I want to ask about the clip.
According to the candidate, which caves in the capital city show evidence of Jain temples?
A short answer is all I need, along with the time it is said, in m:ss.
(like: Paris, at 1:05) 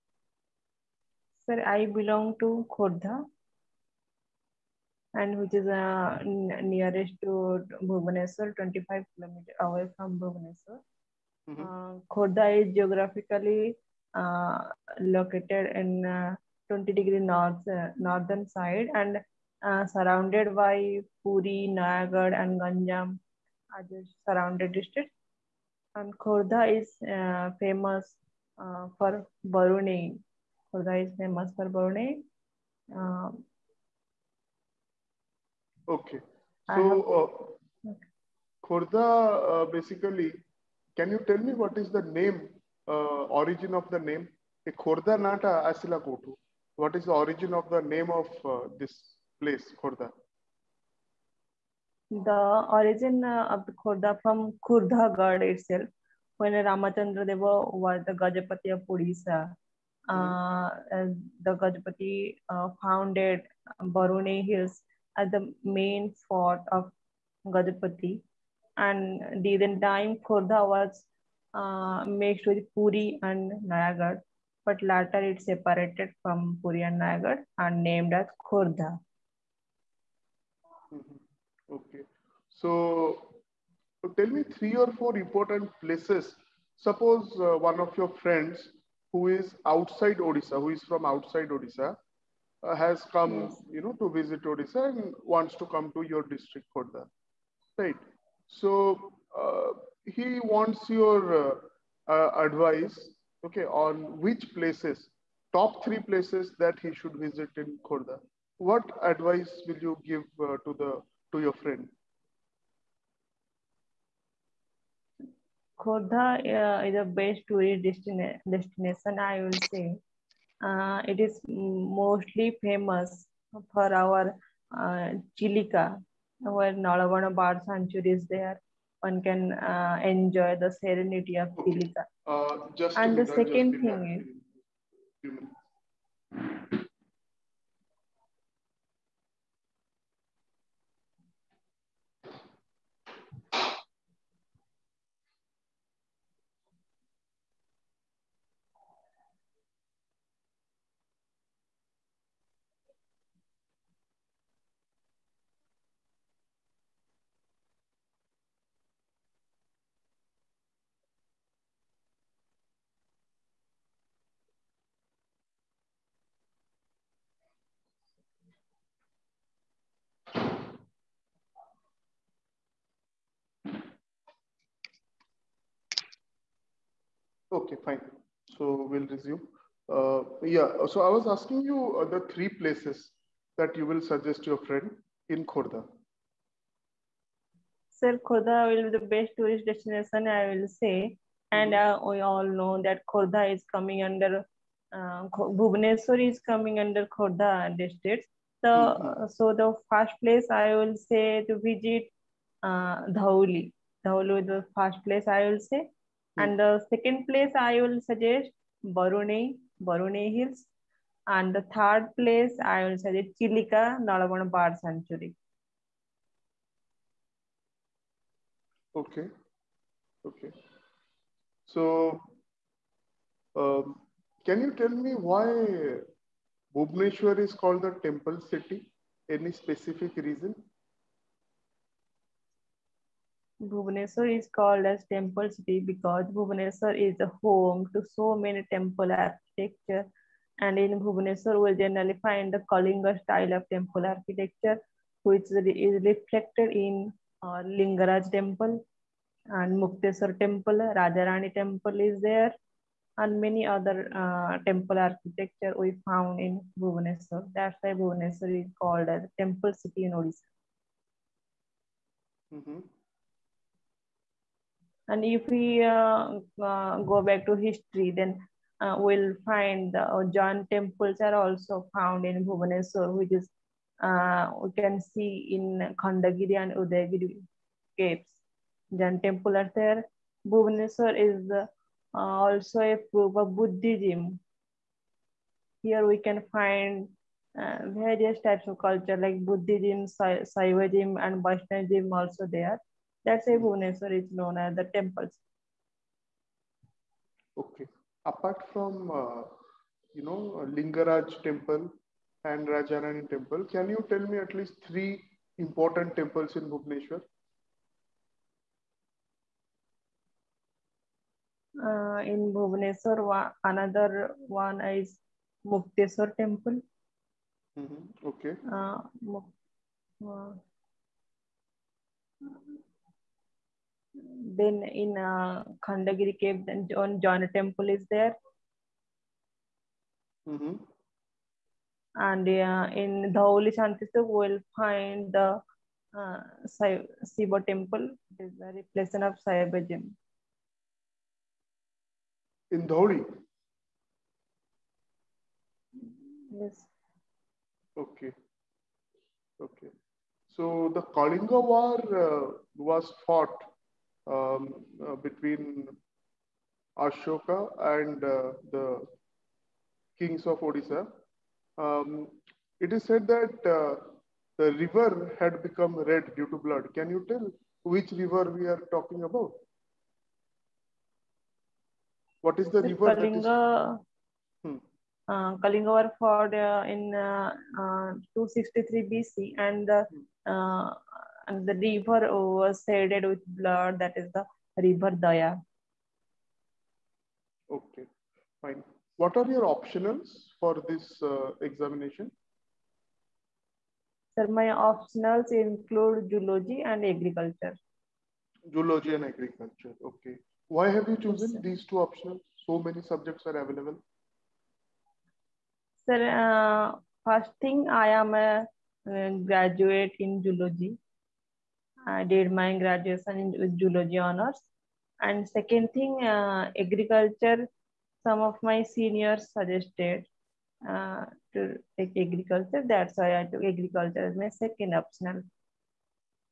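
Khandagiri and Udayagiri, at 4:35.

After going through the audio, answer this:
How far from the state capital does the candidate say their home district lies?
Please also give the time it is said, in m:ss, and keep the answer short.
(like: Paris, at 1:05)
25 km, at 0:08.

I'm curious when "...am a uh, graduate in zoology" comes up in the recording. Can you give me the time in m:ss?
6:48.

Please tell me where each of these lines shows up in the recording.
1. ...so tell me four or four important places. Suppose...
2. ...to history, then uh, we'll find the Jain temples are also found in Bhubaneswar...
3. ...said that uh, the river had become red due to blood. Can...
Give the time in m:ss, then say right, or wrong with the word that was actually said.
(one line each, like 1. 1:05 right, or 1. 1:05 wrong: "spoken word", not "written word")
1. 1:22 wrong: "three", not "four"
2. 4:27 right
3. 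6:03 right.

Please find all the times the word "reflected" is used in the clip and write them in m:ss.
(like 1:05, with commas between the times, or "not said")
4:06.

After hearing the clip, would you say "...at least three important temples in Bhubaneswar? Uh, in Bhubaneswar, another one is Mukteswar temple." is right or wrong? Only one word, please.
right.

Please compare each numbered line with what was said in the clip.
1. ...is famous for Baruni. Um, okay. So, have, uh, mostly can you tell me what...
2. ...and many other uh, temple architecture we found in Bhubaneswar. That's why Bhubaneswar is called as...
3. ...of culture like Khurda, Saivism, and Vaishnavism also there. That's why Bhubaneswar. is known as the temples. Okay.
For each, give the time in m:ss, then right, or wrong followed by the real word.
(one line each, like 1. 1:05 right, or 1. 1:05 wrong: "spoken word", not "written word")
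1. 0:31 wrong: "basically", not "mostly"
2. 4:13 right
3. 4:48 wrong: "Buddhism", not "Khurda".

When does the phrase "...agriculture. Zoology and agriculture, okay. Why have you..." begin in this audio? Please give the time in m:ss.
6:37.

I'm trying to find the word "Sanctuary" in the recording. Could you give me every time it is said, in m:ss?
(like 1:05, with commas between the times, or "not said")
2:07, 3:34.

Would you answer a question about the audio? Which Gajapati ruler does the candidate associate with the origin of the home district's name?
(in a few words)
Ramachandra Deva.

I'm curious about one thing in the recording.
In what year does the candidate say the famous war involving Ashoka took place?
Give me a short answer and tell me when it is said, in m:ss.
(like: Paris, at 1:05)
263 BC, at 6:18.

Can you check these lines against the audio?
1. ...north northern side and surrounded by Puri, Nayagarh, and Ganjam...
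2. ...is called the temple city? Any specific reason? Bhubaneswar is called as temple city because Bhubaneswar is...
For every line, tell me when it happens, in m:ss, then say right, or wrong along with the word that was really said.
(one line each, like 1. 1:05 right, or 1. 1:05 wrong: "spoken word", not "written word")
1. 0:17 right
2. 3:47 right.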